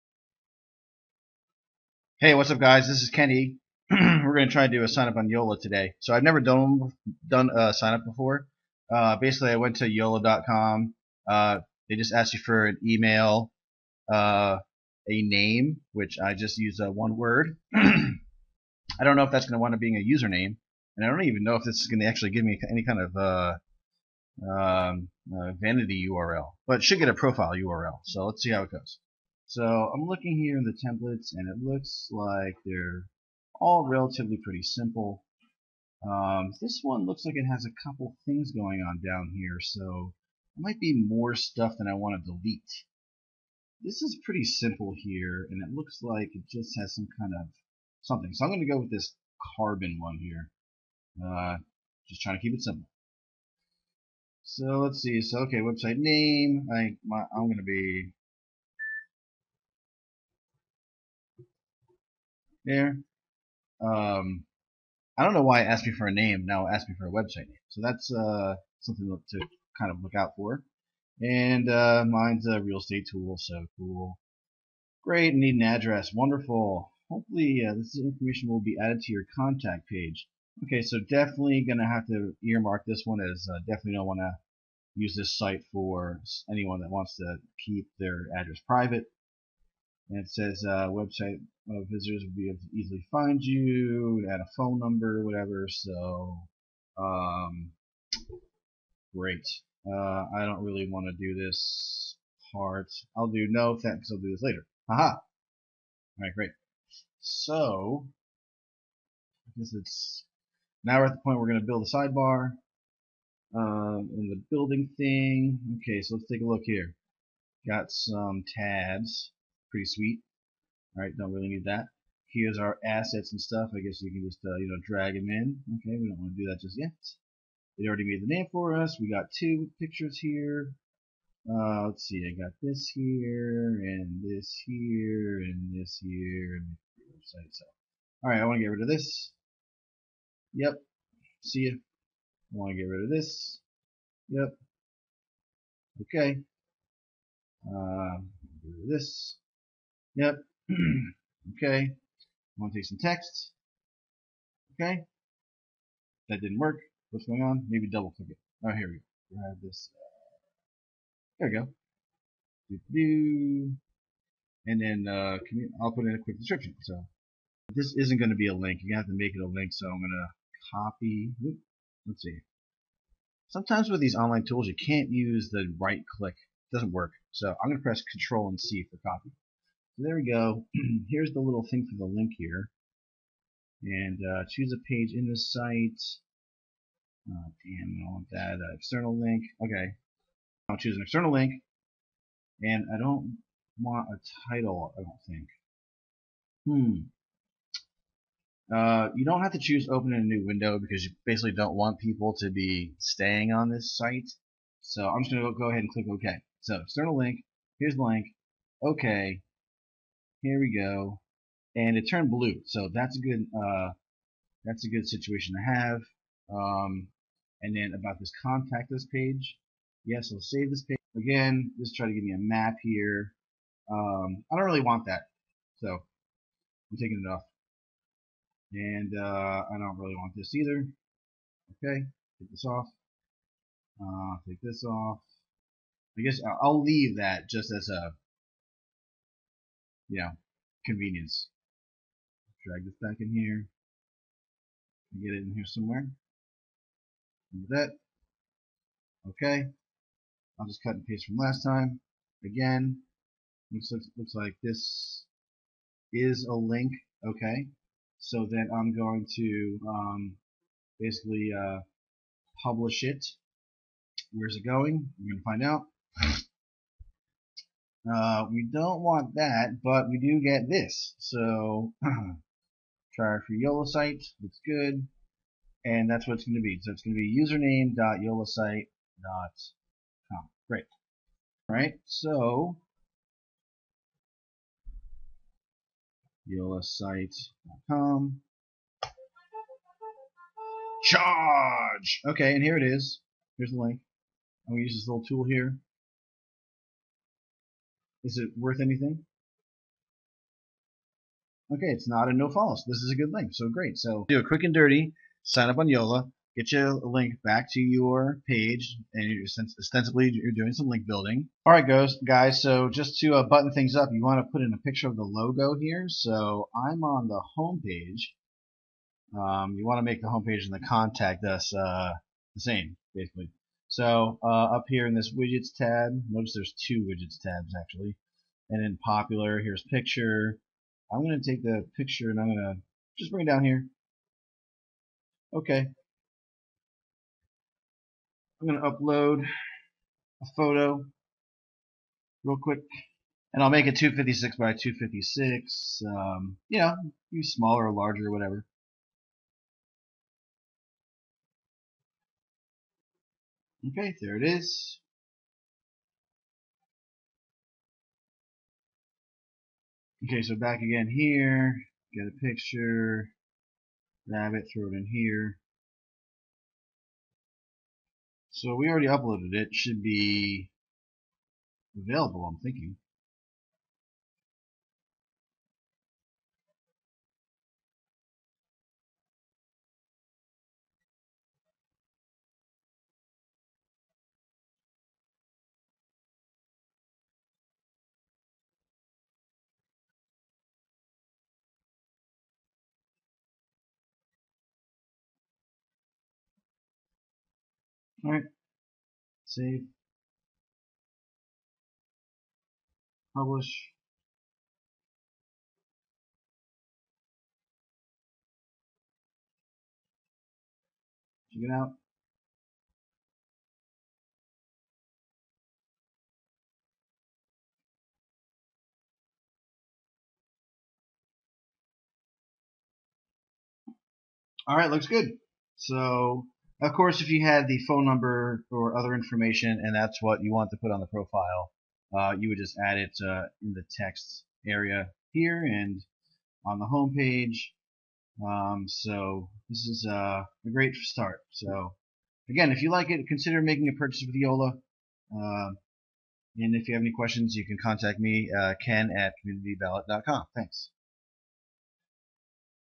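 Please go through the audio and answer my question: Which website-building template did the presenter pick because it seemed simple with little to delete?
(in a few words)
carbon.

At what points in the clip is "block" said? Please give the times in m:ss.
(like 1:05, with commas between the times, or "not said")
not said.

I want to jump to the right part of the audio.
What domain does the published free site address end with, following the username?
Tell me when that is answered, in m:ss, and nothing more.
4:46.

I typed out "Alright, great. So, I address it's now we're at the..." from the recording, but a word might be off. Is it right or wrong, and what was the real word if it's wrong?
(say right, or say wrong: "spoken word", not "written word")
wrong: "guess", not "address".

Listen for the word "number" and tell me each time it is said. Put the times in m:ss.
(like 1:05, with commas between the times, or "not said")
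1:34, 7:08.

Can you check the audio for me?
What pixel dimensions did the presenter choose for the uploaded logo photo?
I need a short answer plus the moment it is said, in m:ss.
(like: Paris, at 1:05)
256 by 256, at 5:43.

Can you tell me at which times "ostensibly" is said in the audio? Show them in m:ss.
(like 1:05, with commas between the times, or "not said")
5:09.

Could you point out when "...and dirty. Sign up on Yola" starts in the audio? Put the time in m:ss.
5:04.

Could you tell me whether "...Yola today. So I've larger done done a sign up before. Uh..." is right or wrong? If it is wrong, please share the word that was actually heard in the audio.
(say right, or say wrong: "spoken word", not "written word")
wrong: "never", not "larger".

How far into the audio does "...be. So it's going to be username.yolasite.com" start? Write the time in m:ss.
4:36.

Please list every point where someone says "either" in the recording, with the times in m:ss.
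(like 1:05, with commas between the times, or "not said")
3:50.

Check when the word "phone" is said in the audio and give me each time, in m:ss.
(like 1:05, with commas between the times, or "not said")
1:34, 7:07.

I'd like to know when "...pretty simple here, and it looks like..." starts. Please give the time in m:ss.
0:44.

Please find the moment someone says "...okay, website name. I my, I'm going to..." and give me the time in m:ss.
0:55.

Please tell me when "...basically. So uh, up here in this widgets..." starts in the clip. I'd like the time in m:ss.
5:23.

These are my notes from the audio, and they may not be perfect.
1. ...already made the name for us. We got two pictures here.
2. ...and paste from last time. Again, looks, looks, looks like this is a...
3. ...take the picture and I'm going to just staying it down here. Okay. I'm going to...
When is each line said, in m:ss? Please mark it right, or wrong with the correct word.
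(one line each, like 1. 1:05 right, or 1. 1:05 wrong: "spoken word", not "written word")
1. 2:07 right
2. 4:10 right
3. 5:31 wrong: "bring", not "staying".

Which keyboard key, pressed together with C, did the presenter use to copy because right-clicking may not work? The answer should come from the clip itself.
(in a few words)
Control.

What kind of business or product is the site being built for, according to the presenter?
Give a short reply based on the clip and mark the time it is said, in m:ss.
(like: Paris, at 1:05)
real estate tool, at 1:12.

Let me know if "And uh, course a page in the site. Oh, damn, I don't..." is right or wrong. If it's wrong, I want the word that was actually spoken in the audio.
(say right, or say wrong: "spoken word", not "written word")
wrong: "choose", not "course".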